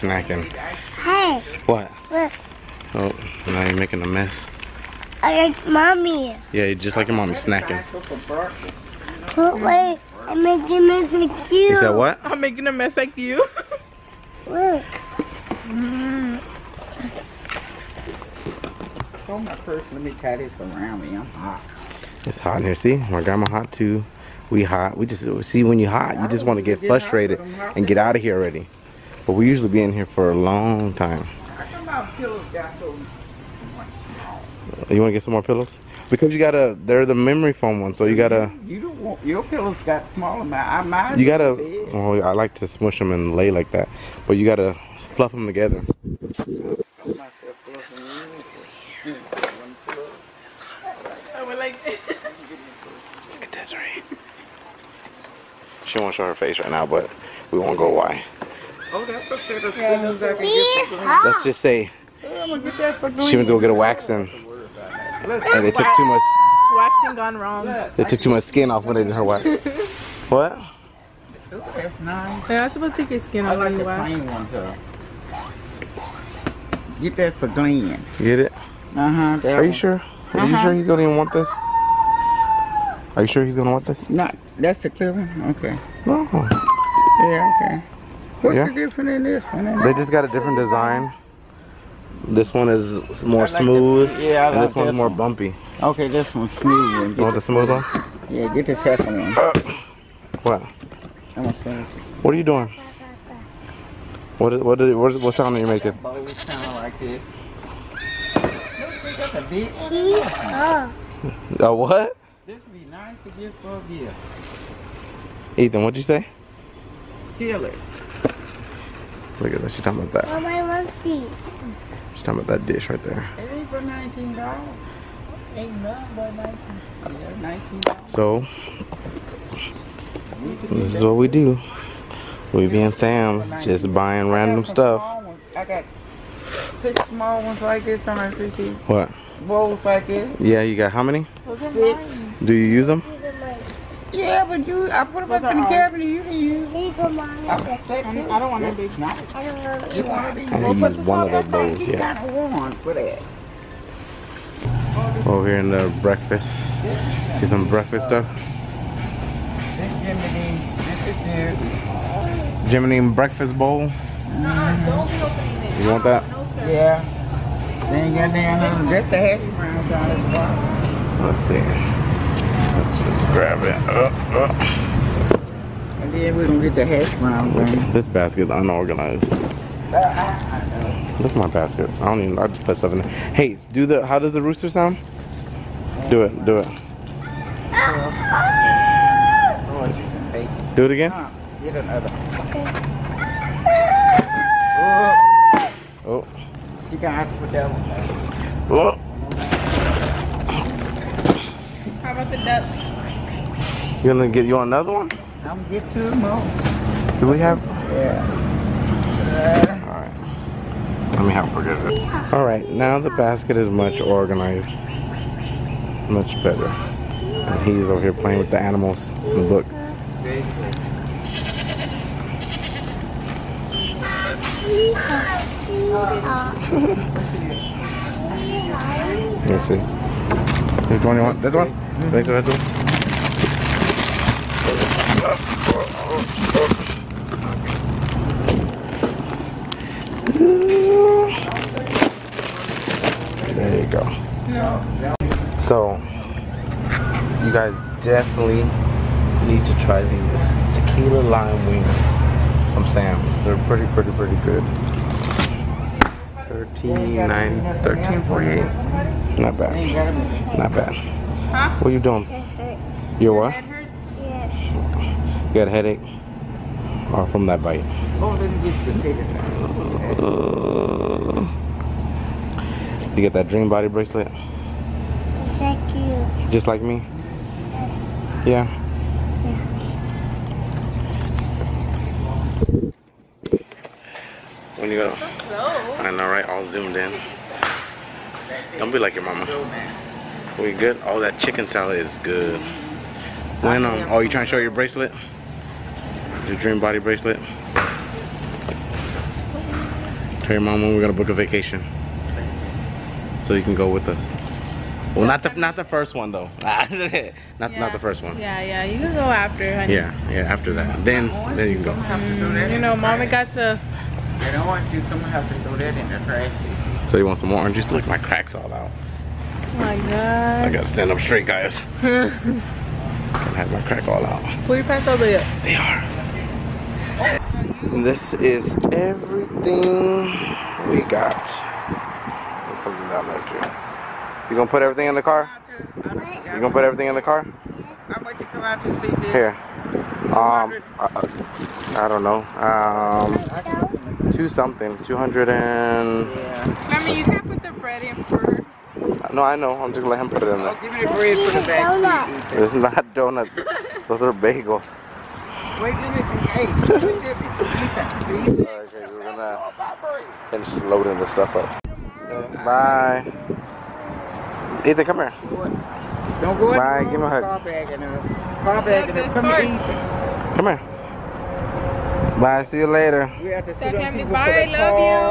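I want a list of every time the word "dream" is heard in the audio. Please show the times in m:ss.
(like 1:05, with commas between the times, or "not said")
4:33, 4:56.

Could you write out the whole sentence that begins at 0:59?
Let's just say she went to go get a waxing.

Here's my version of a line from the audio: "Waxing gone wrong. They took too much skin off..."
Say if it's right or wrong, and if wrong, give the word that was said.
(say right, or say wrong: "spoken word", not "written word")
right.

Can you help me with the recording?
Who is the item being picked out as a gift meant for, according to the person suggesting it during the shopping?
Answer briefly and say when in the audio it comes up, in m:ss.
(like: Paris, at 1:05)
Glenn, at 1:17.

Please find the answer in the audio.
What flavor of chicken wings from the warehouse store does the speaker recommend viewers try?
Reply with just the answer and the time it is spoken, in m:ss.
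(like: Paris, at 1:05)
Tequila lime, at 4:10.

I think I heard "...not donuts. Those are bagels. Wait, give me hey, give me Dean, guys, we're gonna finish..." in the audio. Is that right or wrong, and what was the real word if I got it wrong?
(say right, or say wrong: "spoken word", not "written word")
wrong: "Alright", not "Dean".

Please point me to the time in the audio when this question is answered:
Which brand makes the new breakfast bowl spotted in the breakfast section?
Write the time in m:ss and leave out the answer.
2:42.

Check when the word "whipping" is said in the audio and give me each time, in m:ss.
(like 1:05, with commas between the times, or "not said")
3:22.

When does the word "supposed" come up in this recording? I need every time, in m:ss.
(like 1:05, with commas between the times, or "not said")
1:12.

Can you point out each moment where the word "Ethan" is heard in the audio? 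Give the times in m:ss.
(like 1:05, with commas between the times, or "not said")
1:55, 6:04.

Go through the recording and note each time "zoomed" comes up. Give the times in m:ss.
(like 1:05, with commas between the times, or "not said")
4:46.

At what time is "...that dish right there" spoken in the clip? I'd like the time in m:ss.
2:02.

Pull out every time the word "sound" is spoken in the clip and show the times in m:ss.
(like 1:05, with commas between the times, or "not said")
1:45, 3:04.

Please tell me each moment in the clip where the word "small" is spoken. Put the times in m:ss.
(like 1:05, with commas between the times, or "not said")
0:40, 2:17.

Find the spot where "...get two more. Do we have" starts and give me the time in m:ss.
3:25.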